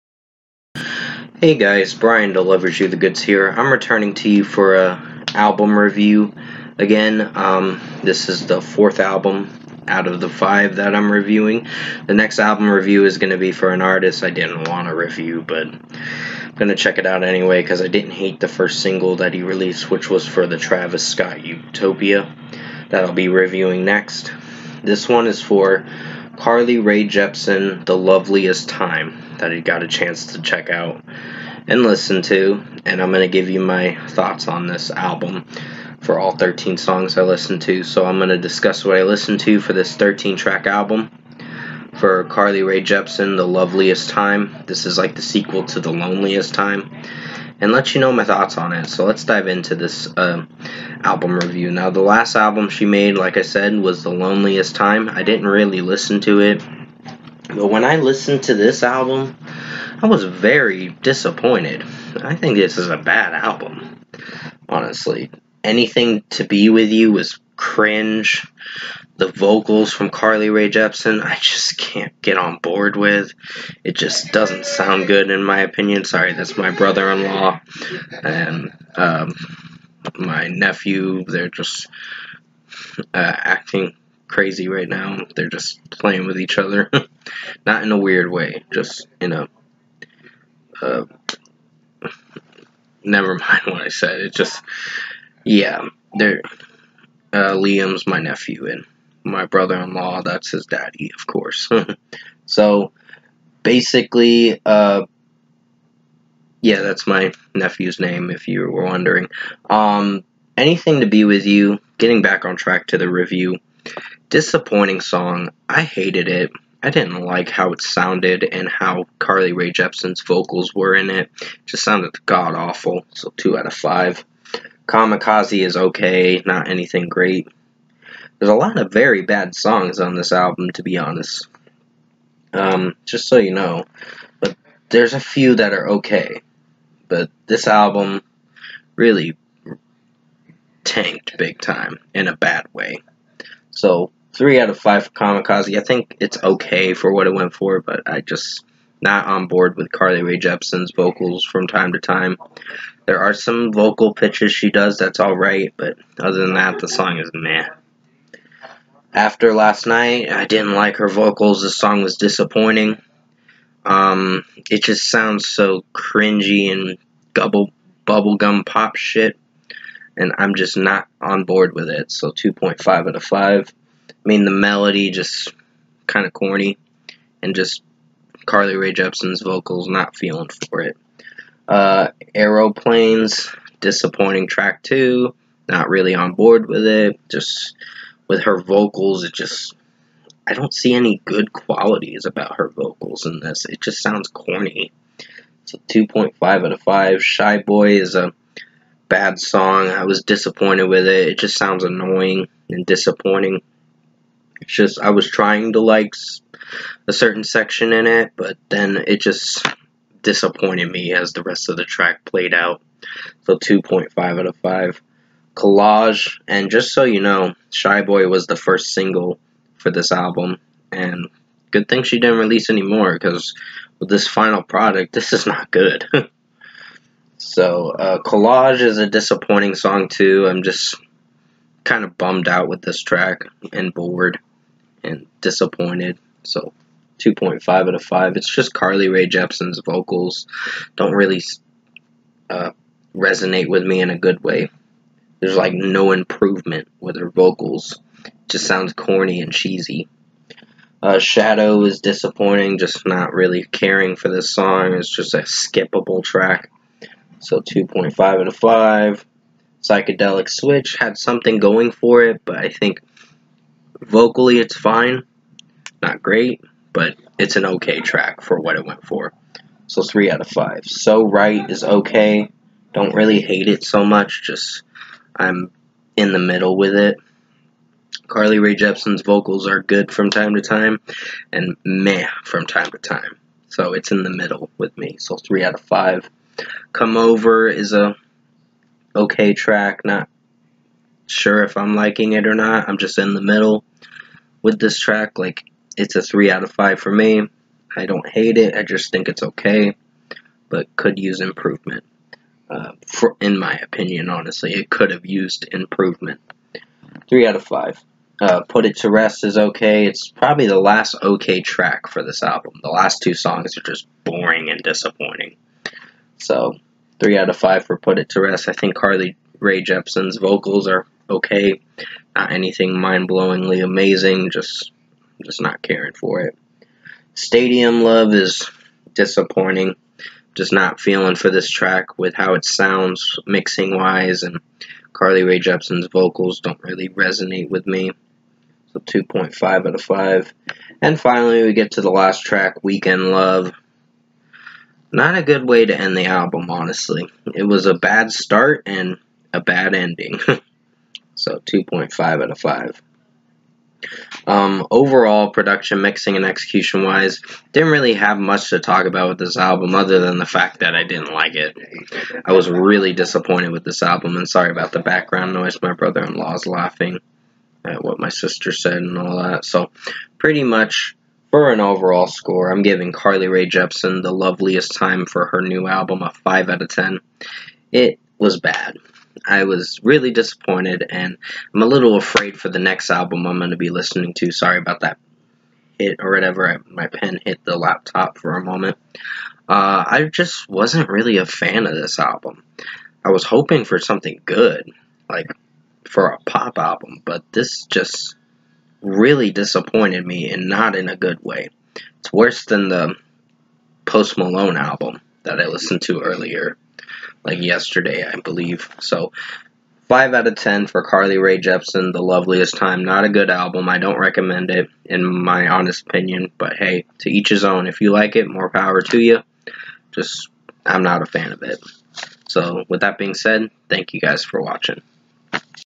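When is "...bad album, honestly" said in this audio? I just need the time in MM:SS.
01:02.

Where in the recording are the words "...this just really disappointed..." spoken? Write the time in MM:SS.
06:37.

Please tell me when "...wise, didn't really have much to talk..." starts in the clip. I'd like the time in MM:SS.
05:57.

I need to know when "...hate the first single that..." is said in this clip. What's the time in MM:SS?
00:18.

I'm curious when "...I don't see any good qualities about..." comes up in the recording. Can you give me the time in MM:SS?
03:10.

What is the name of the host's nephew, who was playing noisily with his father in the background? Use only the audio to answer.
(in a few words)
Liam.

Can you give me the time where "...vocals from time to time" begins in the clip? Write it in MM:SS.
02:30.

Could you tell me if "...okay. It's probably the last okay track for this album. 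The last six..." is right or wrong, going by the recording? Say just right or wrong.
wrong.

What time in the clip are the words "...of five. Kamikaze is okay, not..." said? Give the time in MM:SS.
02:03.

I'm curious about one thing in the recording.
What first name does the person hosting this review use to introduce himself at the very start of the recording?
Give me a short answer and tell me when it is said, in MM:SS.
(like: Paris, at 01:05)
Bryan, at 00:01.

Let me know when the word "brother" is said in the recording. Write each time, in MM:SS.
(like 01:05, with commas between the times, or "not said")
01:16, 01:39, 06:05.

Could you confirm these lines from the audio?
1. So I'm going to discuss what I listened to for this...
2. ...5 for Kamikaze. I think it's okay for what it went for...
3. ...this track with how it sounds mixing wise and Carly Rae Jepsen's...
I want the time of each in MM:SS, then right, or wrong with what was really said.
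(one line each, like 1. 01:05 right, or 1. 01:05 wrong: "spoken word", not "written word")
1. 00:37 right
2. 02:24 right
3. 05:31 right.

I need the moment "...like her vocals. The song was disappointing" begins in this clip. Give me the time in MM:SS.
02:40.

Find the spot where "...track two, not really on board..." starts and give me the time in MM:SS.
03:04.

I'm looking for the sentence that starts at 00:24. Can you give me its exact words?
This one is for Carly Rae Jepsen, The Loveliest Time, that I got a chance to check out and listen to.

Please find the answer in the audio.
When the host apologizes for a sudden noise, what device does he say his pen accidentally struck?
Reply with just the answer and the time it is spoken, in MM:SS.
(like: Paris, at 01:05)
laptop, at 06:27.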